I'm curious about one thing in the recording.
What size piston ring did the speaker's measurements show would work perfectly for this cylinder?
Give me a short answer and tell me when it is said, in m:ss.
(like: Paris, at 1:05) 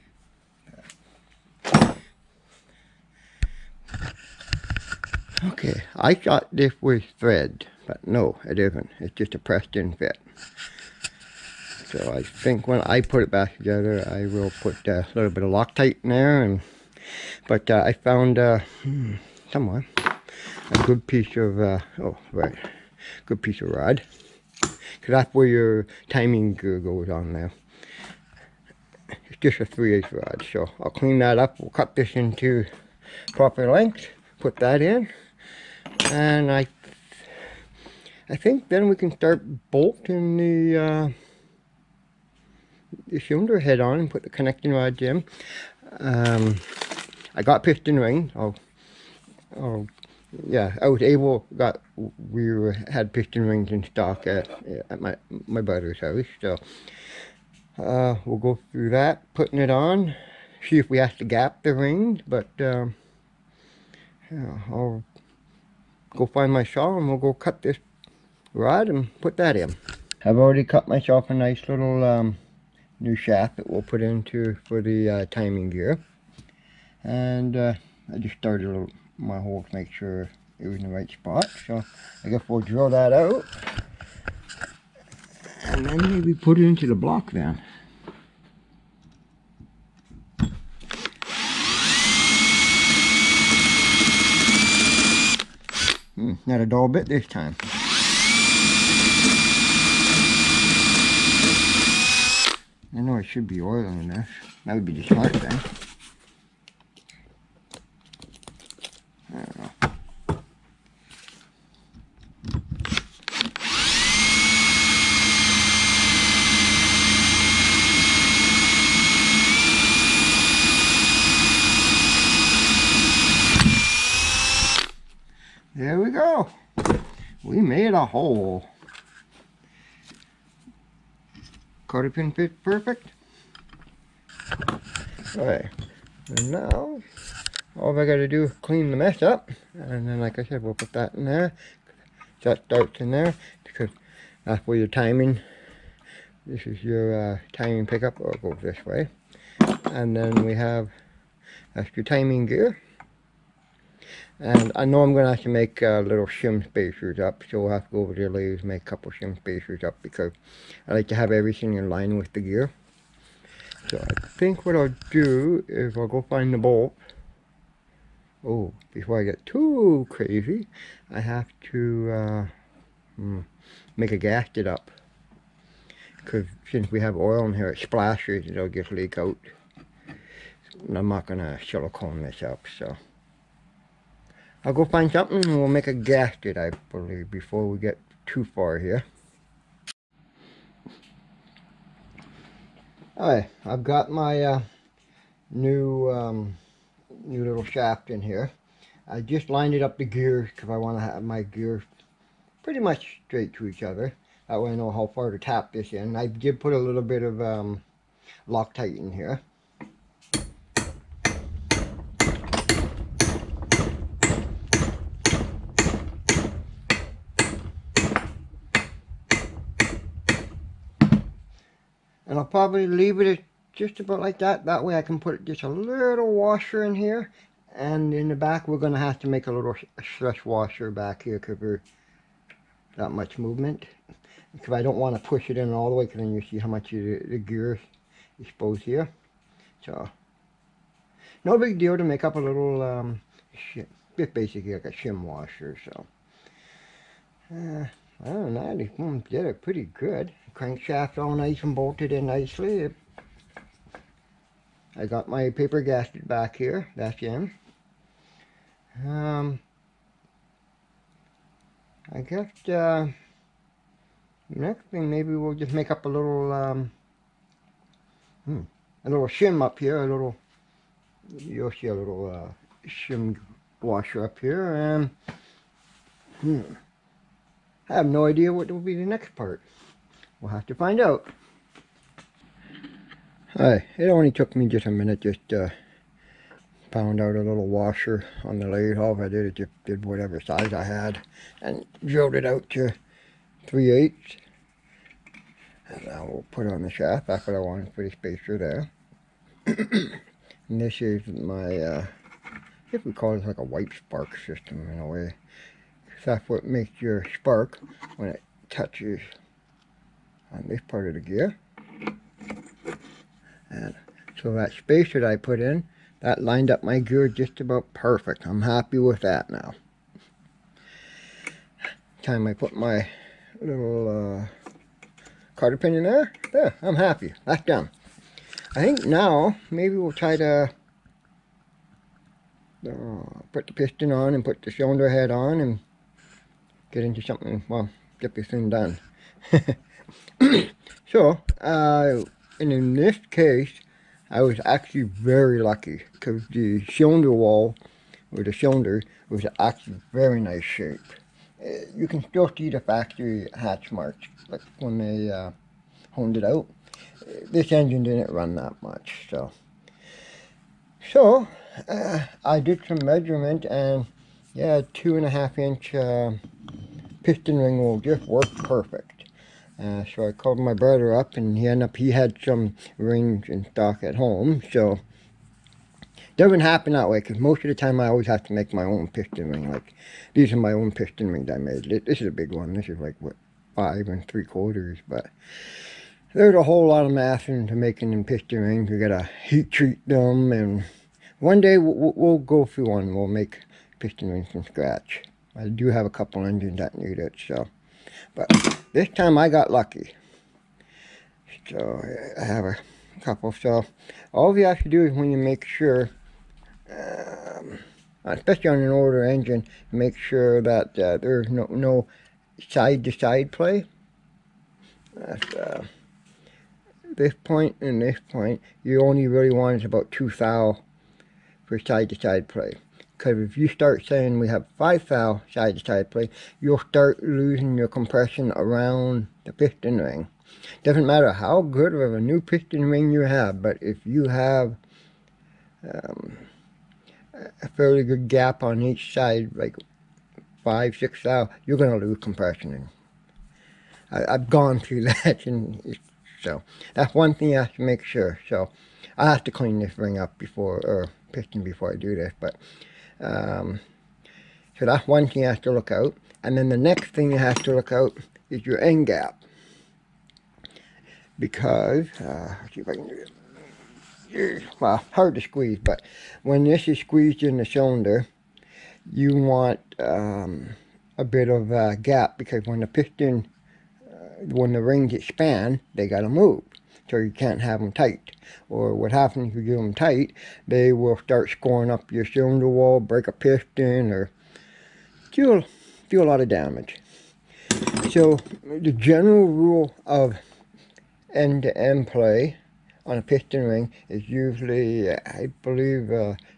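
2.5 inch, at 6:04.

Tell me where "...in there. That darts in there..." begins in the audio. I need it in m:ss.
2:21.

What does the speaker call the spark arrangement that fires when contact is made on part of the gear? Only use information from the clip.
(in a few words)
wipe spark system.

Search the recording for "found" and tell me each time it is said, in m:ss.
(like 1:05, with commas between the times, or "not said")
0:17, 4:46.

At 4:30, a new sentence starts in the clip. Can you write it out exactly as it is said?
A little you'll see a little uh, shim washer up here and.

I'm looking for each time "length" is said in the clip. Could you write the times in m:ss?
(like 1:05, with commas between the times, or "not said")
0:33.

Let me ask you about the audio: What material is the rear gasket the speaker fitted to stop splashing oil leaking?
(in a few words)
paper.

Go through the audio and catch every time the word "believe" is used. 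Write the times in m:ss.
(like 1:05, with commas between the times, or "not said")
3:06, 8:15.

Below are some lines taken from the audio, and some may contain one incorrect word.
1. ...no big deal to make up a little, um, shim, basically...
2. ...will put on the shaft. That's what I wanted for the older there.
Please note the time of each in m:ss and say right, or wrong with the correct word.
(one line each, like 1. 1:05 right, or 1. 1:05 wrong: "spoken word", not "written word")
1. 4:01 right
2. 4:56 wrong: "spacer", not "older".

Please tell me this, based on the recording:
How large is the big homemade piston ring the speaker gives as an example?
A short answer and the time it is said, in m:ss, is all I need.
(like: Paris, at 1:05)
5 3/4, at 6:23.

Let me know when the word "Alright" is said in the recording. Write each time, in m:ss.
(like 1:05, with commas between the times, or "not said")
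2:15, 3:13.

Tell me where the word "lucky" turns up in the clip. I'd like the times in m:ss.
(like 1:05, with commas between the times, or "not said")
5:45, 6:39.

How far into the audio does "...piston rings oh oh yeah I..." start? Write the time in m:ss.
0:47.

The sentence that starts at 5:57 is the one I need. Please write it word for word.
Uh, this engine didn't run that much, so.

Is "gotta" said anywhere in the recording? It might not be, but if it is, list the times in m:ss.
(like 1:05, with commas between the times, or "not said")
2:18, 6:28.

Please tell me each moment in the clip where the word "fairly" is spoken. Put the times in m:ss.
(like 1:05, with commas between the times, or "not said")
7:17.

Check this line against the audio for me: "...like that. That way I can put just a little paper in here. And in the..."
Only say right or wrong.
wrong.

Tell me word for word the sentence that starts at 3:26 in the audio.
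I did put a little bit of um, Loctite in here.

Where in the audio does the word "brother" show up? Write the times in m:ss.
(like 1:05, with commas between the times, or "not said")
0:55, 6:10.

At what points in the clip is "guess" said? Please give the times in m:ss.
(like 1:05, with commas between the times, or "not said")
1:22, 4:22.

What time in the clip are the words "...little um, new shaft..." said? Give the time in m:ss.
1:11.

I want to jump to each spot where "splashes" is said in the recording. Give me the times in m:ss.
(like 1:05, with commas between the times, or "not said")
2:57.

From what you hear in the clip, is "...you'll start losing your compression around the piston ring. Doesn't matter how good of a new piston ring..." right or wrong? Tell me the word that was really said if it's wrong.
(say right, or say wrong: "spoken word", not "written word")
right.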